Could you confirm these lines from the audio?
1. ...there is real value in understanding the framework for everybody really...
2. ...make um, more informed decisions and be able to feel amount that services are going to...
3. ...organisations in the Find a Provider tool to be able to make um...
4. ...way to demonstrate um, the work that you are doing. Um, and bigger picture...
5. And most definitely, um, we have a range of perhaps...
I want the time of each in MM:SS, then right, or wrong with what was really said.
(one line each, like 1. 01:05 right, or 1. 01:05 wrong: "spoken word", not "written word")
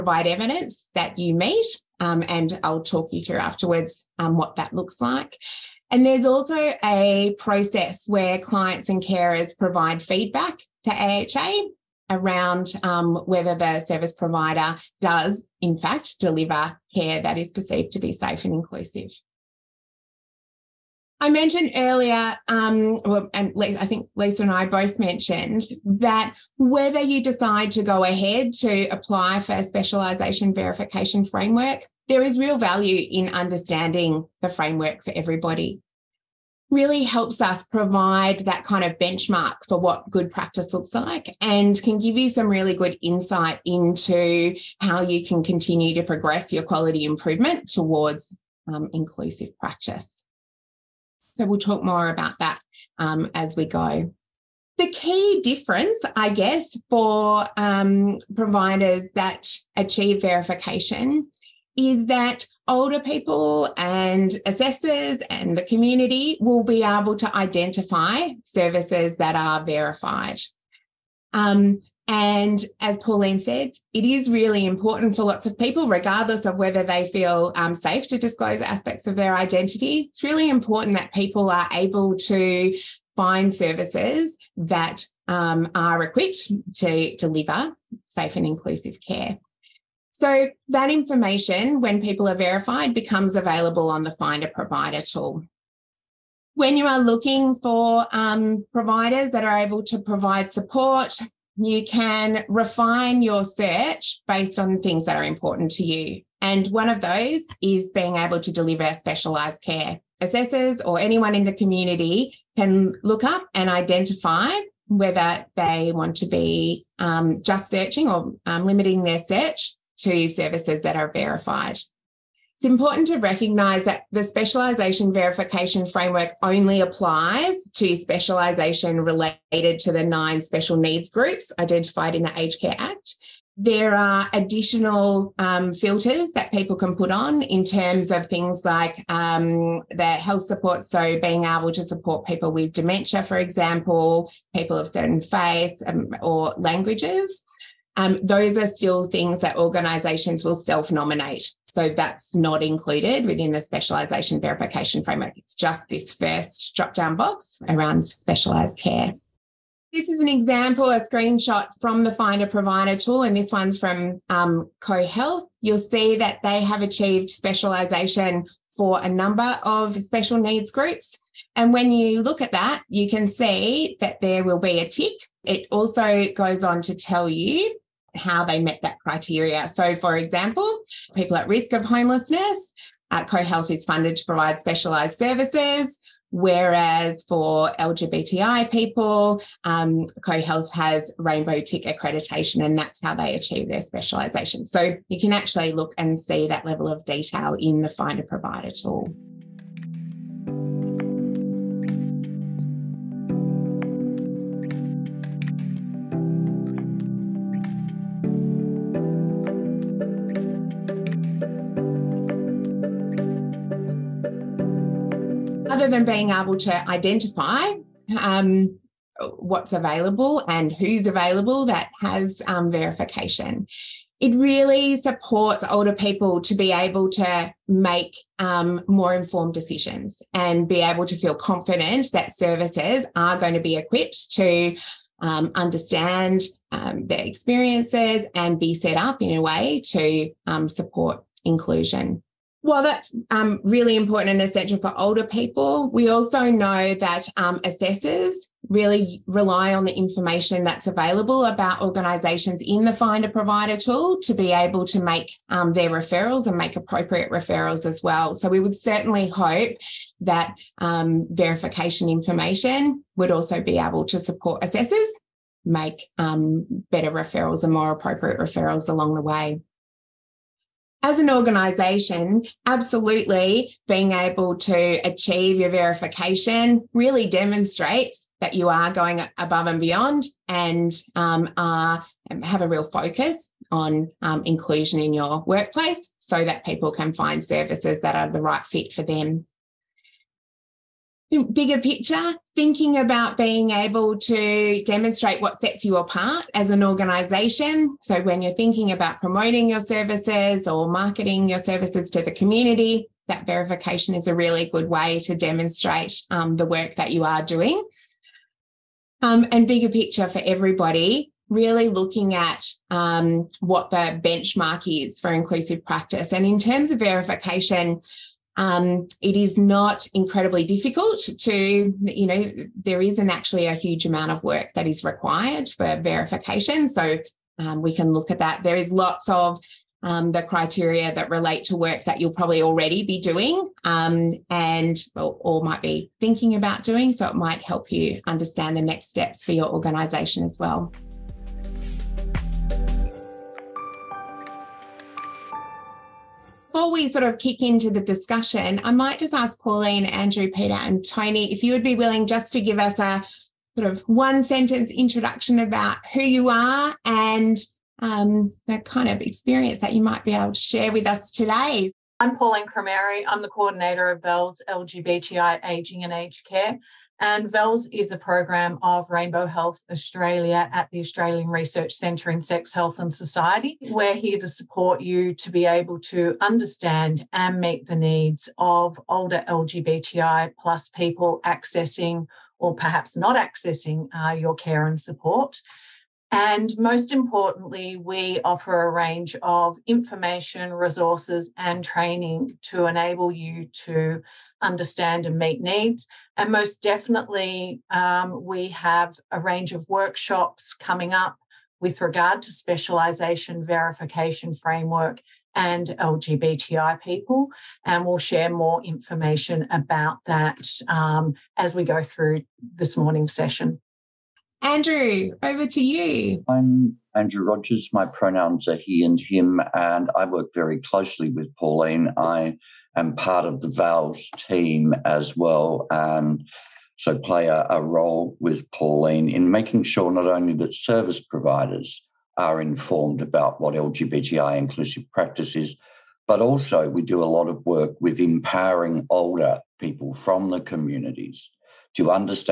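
1. 00:32 right
2. 03:47 wrong: "confident", not "amount"
3. 04:11 right
4. 05:04 right
5. 06:36 wrong: "workshops", not "perhaps".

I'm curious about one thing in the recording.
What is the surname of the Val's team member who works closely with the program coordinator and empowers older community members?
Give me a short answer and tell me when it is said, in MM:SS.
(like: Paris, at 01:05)
Rogers, at 06:57.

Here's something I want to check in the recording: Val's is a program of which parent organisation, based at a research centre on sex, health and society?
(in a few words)
Rainbow Health Australia.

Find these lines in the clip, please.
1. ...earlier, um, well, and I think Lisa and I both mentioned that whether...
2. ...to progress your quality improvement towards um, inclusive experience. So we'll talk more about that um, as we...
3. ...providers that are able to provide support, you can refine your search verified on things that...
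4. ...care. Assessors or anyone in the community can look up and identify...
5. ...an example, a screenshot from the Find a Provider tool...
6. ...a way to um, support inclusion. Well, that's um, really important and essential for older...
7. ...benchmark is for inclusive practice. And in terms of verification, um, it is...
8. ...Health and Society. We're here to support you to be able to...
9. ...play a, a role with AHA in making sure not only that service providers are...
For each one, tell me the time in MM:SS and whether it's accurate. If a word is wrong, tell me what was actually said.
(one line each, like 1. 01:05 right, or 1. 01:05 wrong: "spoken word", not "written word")
1. 00:21 right
2. 00:45 wrong: "practice", not "experience"
3. 01:38 wrong: "based", not "verified"
4. 01:49 right
5. 02:40 right
6. 03:59 right
7. 05:14 right
8. 06:12 right
9. 07:07 wrong: "Pauline", not "AHA".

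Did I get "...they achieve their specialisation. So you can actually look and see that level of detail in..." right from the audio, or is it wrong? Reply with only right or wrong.
right.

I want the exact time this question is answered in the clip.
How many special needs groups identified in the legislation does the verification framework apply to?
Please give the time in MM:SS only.
02:10.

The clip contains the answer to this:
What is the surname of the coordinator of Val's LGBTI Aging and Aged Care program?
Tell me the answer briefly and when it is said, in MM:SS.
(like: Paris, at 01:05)
Crameri, at 06:02.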